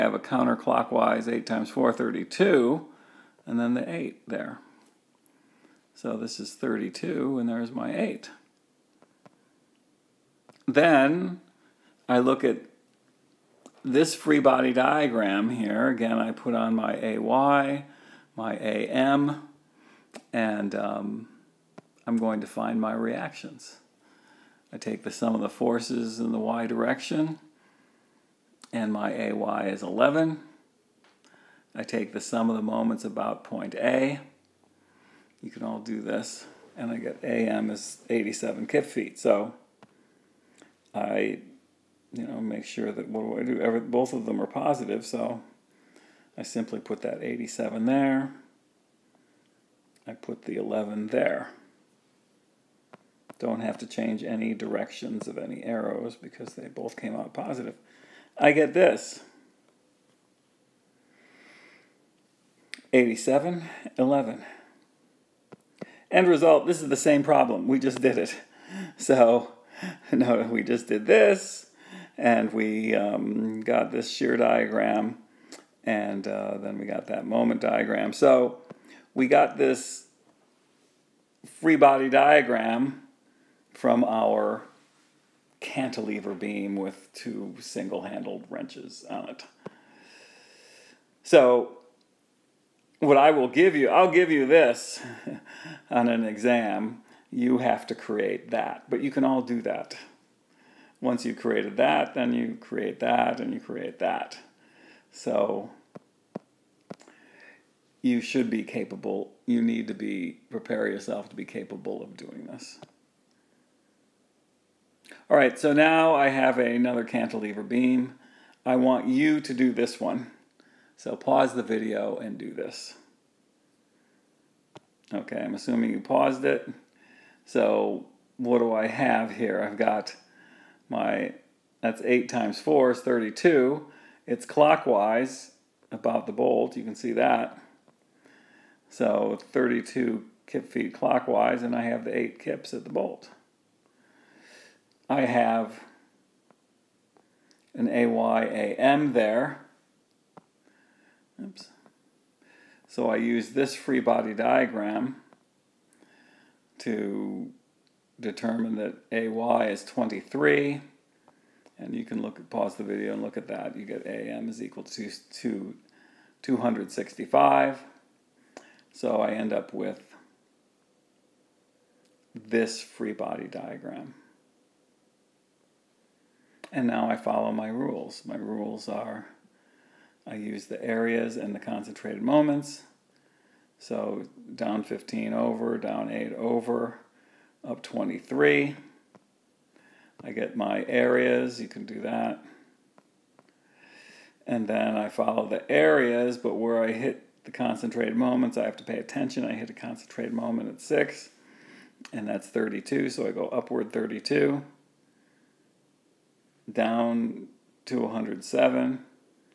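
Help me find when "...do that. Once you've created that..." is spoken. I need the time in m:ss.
1:39.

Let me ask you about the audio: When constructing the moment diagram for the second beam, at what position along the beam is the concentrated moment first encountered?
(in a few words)
6.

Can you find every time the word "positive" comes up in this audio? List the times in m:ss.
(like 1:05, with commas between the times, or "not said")
0:44, 0:57.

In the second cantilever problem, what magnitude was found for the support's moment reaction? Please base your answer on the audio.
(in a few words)
265.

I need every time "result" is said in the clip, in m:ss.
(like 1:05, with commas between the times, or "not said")
1:06.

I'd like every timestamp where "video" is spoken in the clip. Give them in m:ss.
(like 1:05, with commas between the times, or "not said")
2:01, 2:42.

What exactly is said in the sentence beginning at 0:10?
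Then I look at this free body diagram here.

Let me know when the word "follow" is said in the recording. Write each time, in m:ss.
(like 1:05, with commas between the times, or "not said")
2:57, 3:15.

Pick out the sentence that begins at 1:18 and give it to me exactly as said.
So, we got this free body diagram from our cantilever beam with two single-handled wrenches on it.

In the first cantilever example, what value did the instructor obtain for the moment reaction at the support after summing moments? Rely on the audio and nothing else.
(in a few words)
87 kip feet.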